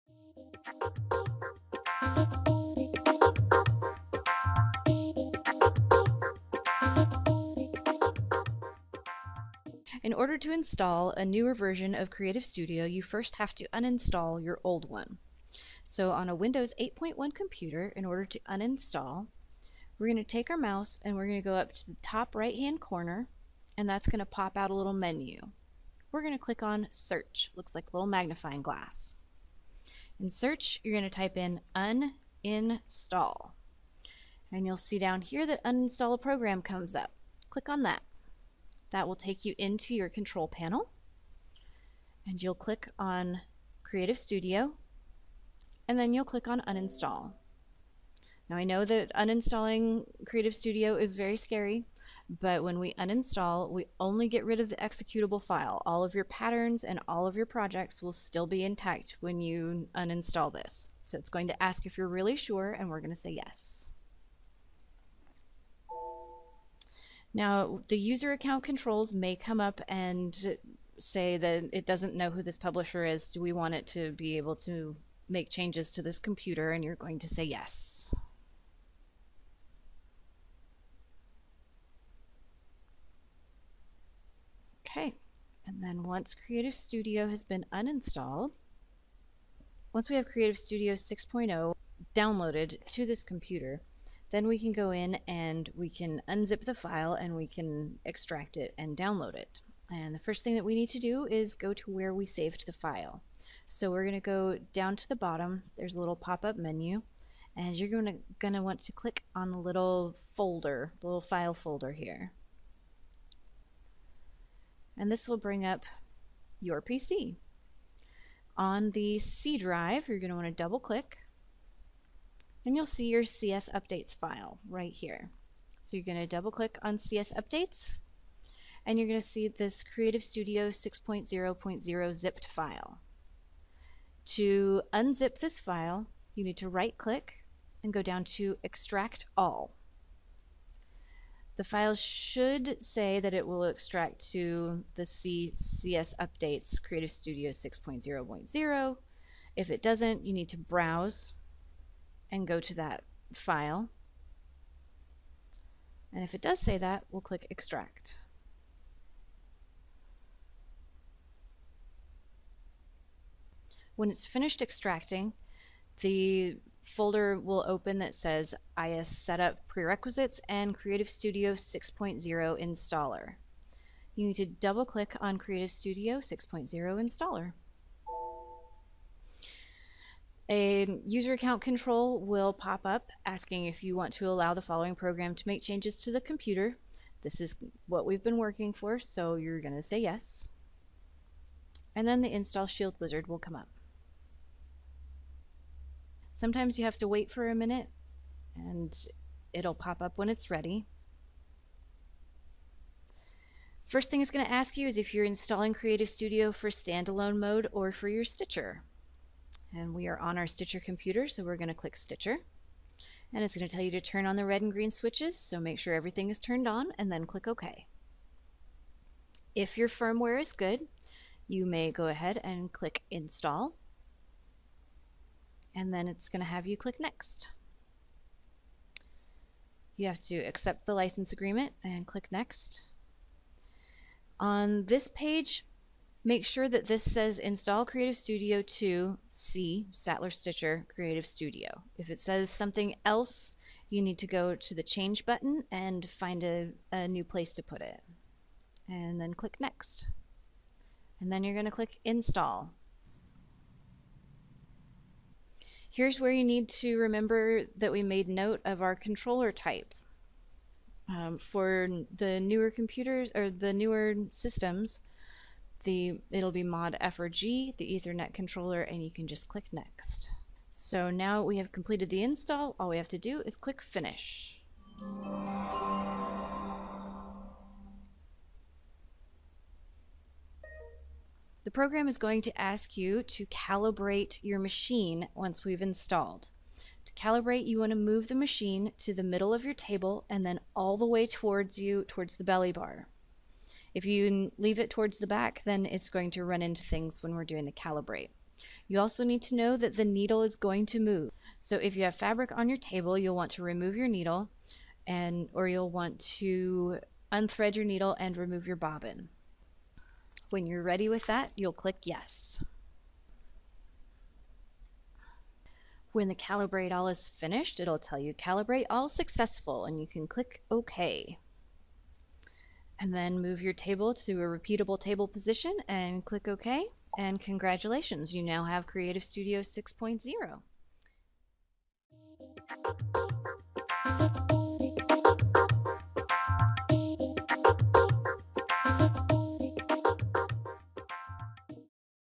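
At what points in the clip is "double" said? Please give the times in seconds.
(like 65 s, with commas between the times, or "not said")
120 s, 126 s, 174 s.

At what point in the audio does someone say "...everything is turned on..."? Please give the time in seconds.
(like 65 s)
215 s.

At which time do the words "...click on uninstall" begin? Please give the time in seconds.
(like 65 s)
46 s.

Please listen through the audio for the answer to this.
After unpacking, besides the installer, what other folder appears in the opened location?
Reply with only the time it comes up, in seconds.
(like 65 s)
168 s.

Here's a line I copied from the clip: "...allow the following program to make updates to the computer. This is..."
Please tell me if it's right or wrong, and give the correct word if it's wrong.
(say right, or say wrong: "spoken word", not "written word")
wrong: "changes", not "updates".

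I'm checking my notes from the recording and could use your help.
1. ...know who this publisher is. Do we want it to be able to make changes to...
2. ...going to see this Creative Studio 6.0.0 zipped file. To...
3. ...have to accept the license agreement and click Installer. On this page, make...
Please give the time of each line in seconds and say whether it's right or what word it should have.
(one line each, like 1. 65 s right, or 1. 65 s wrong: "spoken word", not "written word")
1. 72 s right
2. 129 s right
3. 230 s wrong: "Next", not "Installer".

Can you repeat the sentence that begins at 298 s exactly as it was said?
You also need to know that the needle is going to move.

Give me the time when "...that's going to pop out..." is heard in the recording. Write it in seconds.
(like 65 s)
23 s.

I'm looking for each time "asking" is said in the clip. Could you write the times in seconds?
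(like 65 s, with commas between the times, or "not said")
183 s.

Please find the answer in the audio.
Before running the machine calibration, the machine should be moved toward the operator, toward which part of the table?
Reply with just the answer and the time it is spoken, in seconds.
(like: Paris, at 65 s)
the belly bar, at 292 s.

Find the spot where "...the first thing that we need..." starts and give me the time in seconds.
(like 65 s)
100 s.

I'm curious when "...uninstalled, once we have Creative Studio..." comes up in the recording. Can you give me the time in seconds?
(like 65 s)
87 s.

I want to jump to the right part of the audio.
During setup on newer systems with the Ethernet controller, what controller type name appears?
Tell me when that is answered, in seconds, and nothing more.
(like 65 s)
266 s.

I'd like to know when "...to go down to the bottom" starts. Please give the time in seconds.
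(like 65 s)
104 s.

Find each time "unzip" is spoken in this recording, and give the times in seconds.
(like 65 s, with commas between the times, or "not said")
96 s, 134 s.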